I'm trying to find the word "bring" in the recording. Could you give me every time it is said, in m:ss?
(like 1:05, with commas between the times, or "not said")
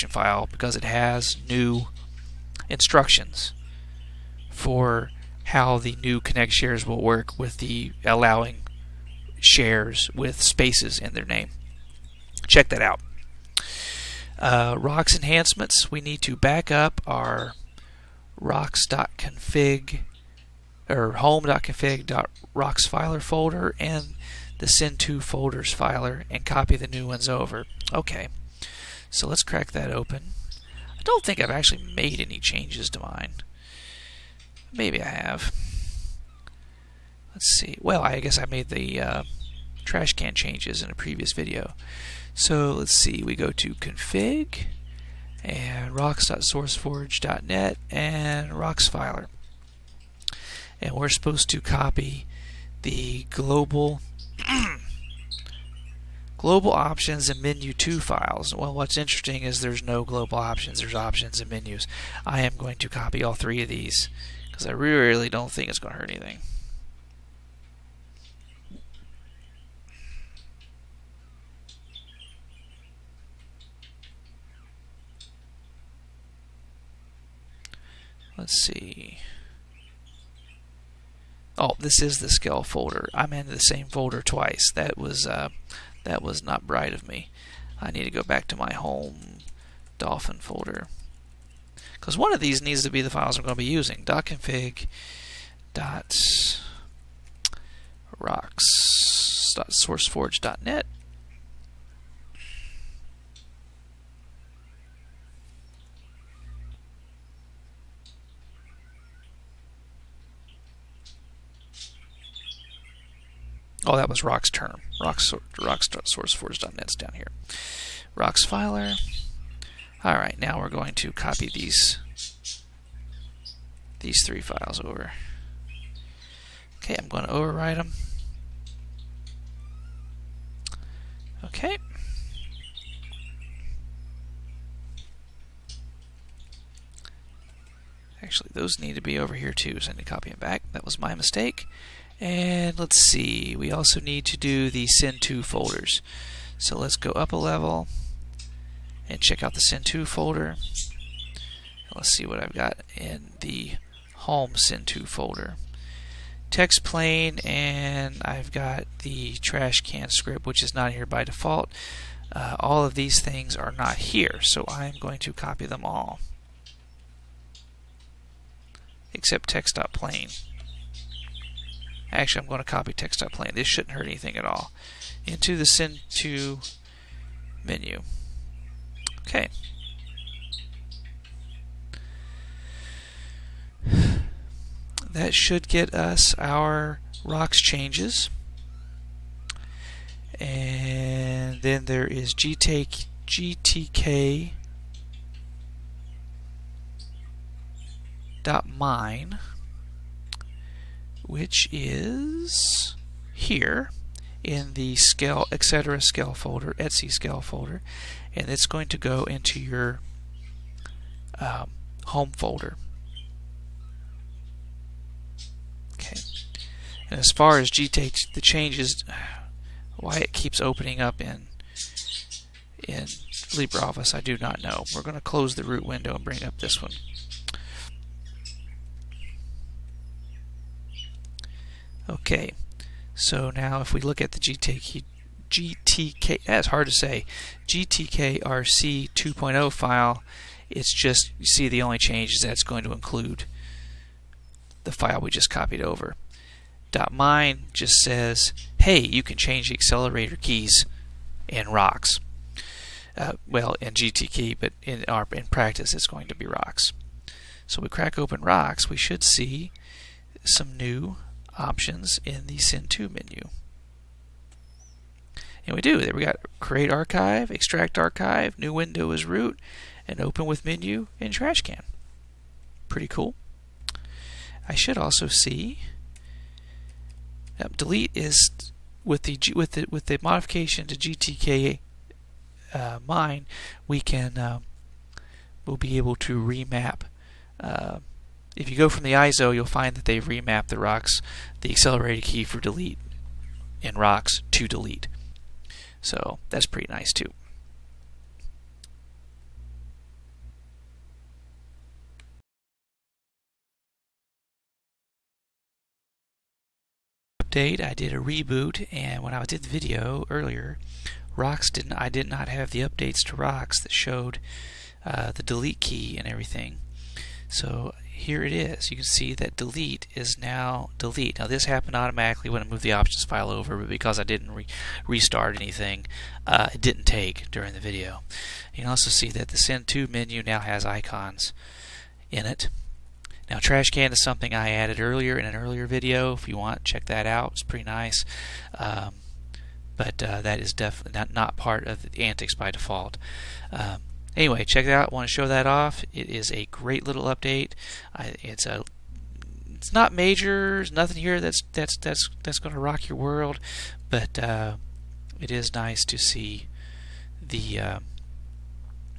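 3:46.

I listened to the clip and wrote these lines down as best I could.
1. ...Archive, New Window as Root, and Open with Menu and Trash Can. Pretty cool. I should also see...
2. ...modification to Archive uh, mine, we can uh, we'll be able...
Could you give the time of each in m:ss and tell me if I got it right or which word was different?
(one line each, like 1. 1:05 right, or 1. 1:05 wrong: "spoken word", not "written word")
1. 4:27 right
2. 4:40 wrong: "GTK", not "Archive".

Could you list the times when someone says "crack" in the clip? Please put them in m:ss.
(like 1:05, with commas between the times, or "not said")
0:29, 4:17.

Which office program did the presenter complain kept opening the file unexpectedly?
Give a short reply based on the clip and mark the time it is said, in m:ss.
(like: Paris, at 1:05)
LibreOffice, at 3:43.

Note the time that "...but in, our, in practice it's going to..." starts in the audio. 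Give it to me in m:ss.
4:14.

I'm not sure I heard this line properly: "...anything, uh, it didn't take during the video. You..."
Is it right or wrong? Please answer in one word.
right.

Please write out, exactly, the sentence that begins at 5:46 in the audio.
It is a great little update.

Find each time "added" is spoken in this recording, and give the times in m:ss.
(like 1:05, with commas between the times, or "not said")
5:34.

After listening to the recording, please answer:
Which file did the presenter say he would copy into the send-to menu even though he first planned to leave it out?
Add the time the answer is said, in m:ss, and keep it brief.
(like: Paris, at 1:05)
text.plane, at 2:52.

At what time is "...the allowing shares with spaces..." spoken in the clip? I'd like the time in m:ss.
0:07.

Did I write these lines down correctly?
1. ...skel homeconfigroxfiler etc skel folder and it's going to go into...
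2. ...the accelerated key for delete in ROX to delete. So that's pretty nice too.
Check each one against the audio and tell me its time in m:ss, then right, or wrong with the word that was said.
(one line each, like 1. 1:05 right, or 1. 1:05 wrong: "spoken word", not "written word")
1. 3:25 wrong: "folder", not "homeconfigroxfiler"
2. 4:51 right.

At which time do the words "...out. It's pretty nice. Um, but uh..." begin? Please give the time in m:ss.
5:37.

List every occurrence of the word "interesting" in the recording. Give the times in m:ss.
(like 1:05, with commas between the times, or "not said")
0:58.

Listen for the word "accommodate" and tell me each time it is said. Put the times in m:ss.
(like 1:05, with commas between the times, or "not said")
not said.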